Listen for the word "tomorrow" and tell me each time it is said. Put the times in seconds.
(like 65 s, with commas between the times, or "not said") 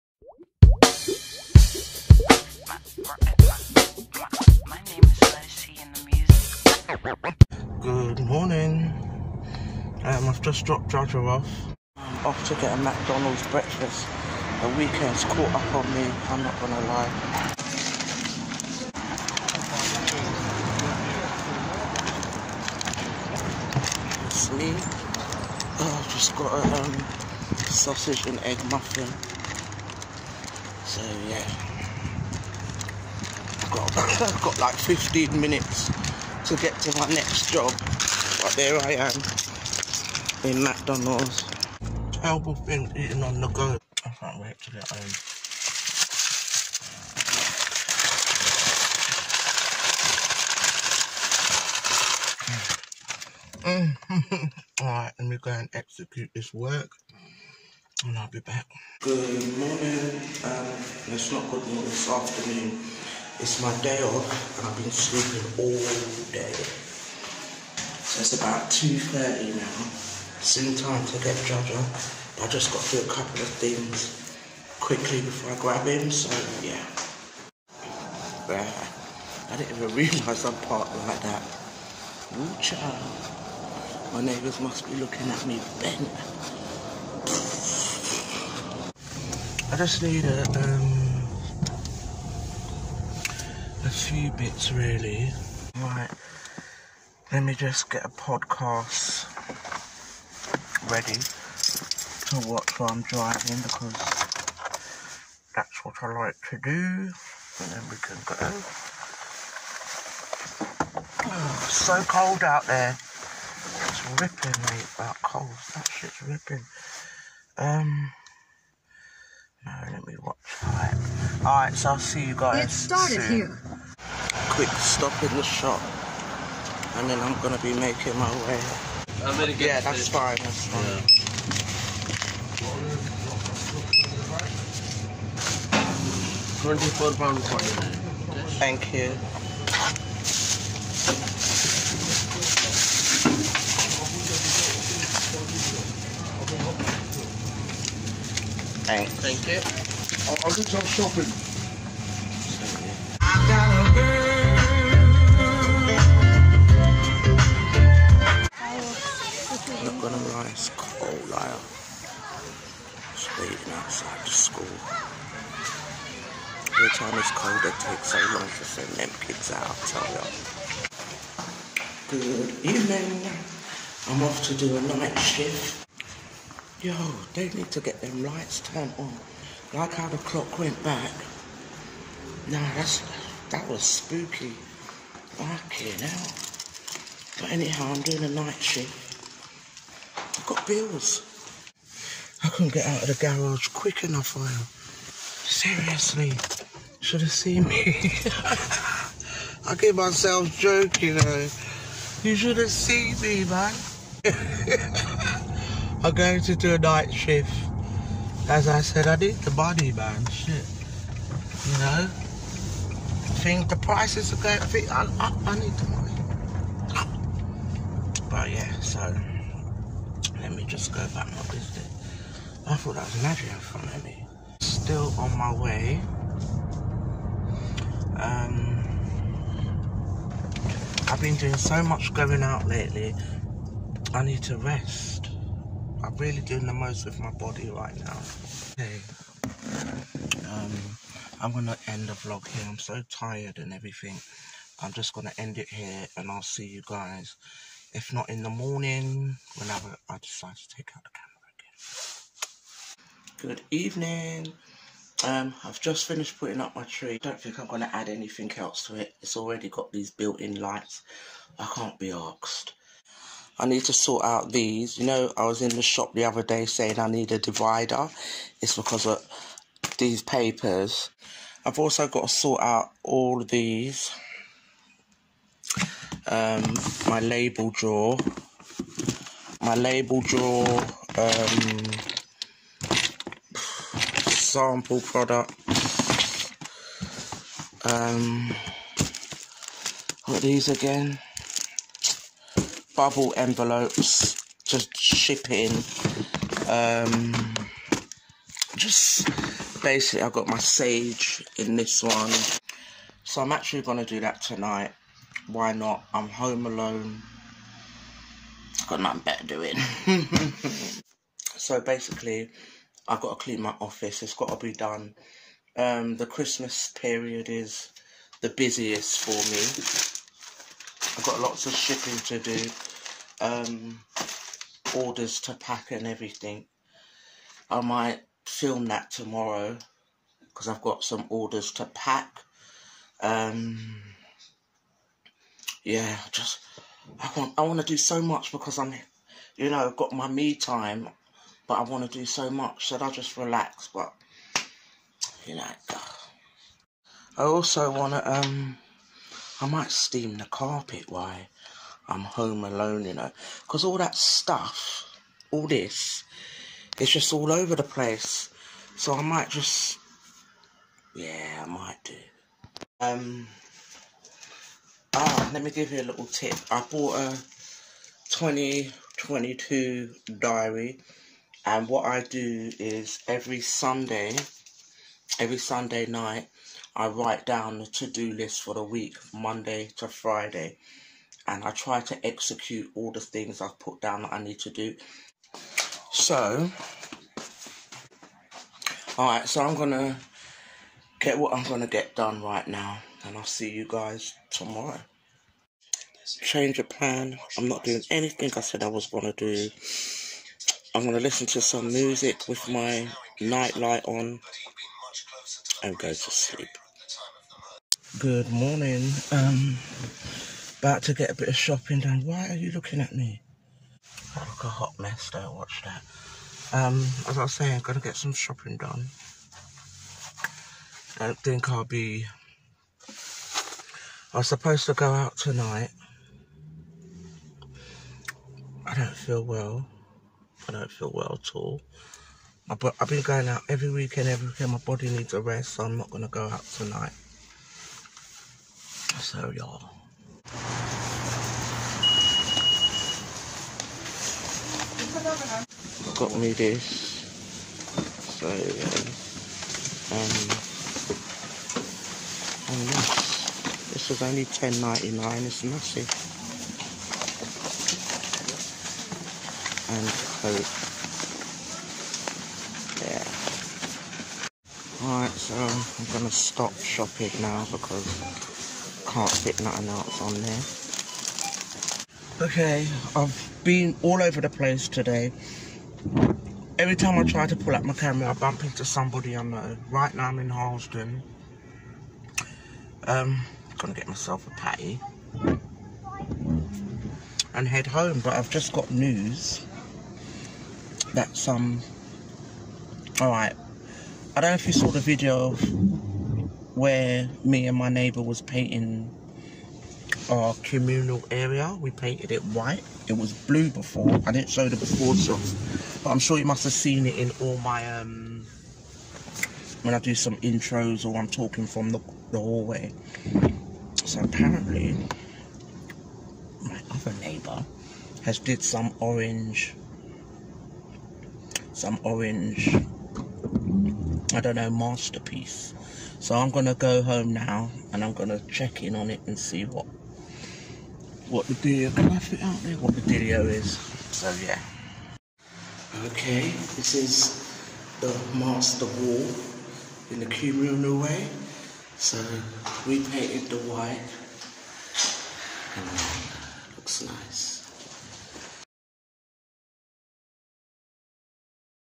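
329 s, 394 s.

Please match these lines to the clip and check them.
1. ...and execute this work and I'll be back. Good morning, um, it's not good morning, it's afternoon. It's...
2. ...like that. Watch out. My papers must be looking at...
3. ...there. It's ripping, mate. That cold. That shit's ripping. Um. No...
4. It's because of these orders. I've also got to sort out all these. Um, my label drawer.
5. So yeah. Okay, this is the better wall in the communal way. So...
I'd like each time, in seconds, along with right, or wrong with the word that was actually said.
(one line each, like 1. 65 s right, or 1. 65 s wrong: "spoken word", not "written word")
1. 55 s right
2. 81 s wrong: "neighbours", not "papers"
3. 112 s right
4. 268 s wrong: "papers", not "orders"
5. 534 s wrong: "master", not "better".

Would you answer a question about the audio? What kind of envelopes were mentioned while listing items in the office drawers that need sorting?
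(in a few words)
Bubble envelopes.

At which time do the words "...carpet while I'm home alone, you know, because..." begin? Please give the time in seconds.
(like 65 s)
350 s.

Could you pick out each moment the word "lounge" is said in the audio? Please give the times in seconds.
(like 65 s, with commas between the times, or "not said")
not said.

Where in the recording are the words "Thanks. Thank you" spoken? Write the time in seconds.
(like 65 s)
148 s.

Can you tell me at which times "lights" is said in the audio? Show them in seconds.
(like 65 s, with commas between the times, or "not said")
178 s, 260 s, 403 s.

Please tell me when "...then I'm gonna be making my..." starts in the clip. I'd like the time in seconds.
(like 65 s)
127 s.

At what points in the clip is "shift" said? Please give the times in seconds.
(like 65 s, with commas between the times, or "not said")
175 s, 188 s, 207 s.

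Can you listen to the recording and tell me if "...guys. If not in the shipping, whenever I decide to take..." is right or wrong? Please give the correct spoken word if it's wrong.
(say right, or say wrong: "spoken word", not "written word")
wrong: "morning", not "shipping".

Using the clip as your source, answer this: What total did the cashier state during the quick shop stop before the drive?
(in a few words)
£24.49.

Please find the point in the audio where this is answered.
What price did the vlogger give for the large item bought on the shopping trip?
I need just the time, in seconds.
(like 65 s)
454 s.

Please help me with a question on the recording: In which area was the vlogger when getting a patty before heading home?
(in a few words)
Harlesden.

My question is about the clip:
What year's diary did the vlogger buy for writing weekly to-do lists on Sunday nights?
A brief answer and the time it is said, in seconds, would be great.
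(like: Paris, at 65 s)
2022, at 368 s.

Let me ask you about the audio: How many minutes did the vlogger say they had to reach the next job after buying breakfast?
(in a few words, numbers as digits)
15.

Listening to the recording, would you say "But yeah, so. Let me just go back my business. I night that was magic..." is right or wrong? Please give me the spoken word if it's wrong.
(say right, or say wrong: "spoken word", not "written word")
wrong: "thought", not "night".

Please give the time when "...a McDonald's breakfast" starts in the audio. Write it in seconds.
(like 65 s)
12 s.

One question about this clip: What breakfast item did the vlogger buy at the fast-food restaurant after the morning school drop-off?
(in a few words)
sausage and egg muffin.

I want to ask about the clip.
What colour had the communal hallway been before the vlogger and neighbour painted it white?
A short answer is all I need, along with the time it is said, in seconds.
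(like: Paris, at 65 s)
blue, at 503 s.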